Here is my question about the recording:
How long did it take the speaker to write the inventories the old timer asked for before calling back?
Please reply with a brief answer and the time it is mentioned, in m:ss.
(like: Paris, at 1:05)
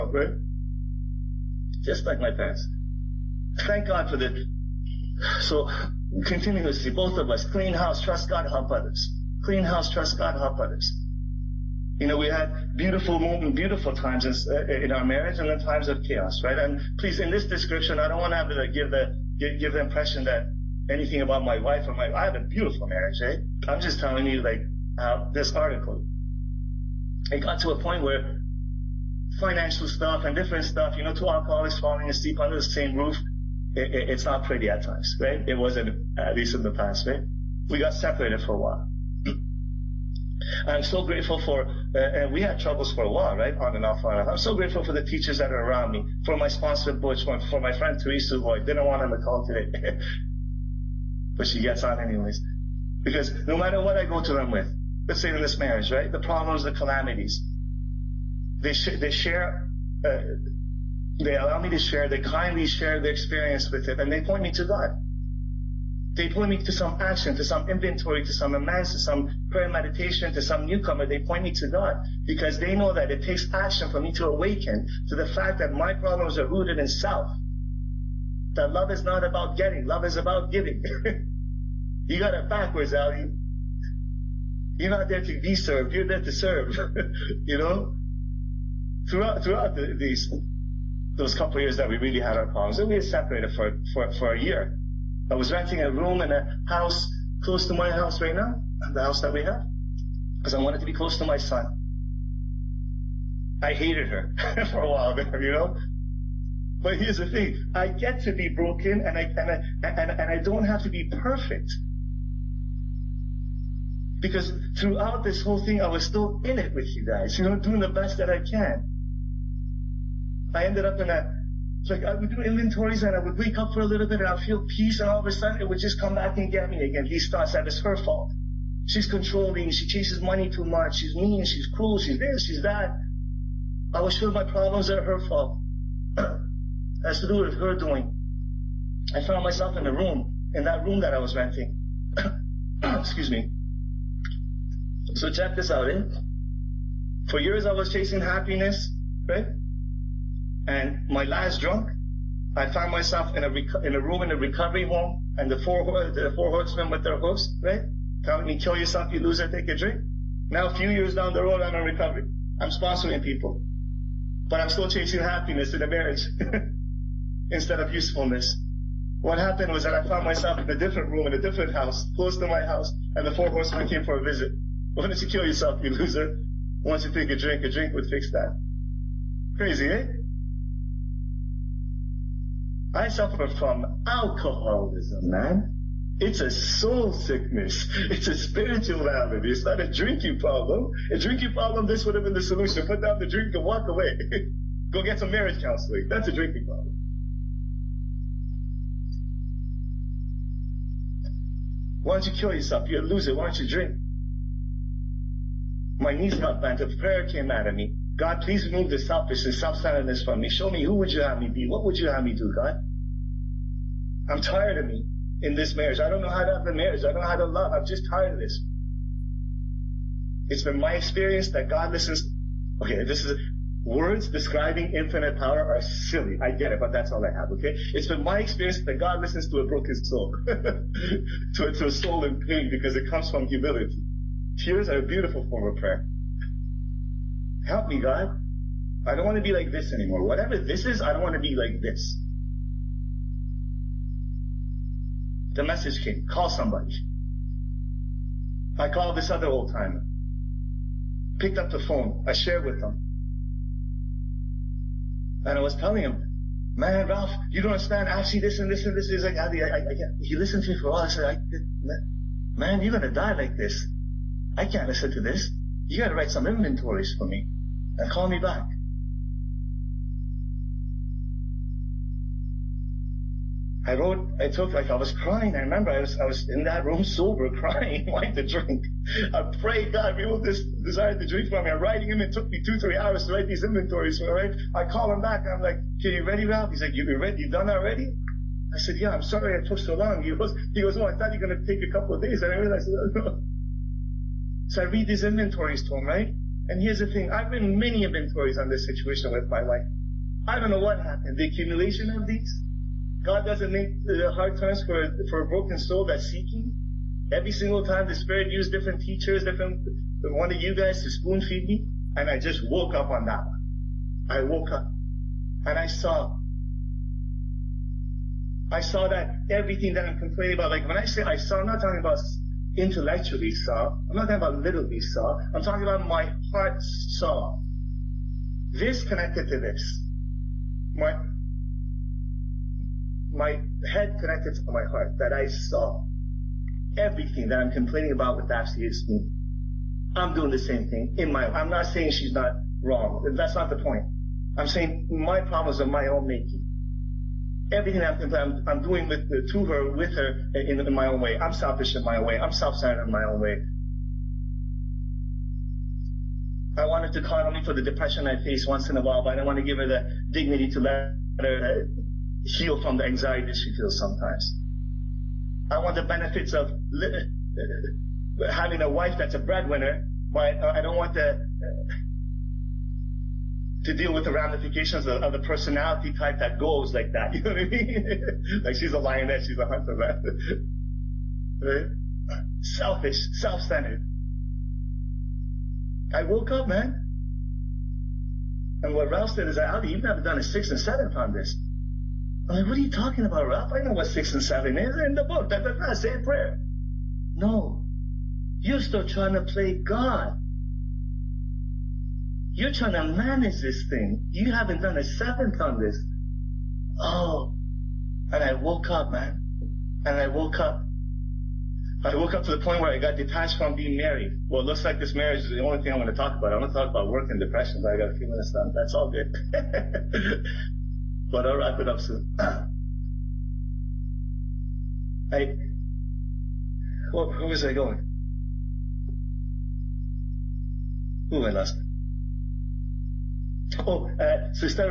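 2 or 3 hours, at 4:42.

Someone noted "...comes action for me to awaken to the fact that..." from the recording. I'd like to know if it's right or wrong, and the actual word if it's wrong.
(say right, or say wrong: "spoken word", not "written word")
wrong: "takes", not "comes".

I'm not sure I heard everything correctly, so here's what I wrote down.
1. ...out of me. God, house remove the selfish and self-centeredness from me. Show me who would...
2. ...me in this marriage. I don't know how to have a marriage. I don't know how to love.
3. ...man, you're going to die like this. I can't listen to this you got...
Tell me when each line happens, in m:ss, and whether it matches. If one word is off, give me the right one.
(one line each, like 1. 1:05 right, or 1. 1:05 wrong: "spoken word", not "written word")
1. 3:27 wrong: "please", not "house"
2. 3:34 right
3. 4:22 right.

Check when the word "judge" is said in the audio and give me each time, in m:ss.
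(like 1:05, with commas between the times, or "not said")
not said.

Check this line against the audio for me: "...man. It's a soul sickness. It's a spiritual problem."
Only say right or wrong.
right.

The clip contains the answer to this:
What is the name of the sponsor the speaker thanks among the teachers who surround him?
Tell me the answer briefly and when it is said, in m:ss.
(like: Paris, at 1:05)
Butch, at 0:46.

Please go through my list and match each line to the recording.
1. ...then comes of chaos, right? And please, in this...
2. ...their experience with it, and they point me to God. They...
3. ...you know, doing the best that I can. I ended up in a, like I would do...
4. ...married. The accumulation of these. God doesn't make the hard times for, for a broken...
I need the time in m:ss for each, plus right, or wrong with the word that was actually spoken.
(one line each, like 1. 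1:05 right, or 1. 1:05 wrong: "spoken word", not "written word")
1. 0:15 wrong: "times", not "comes"
2. 1:03 right
3. 1:57 right
4. 5:00 wrong: "happened", not "married".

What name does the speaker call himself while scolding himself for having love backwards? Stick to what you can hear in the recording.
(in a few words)
Ali.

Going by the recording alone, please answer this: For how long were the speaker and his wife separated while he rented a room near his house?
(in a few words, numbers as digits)
a year.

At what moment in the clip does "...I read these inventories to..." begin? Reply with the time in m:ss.
4:54.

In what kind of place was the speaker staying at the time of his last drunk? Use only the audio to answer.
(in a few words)
a recovery home.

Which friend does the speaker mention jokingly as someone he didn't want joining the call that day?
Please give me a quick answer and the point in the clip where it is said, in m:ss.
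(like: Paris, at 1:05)
Teresa, at 0:48.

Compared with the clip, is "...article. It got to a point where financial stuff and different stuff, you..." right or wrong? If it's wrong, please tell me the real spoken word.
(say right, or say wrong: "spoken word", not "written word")
right.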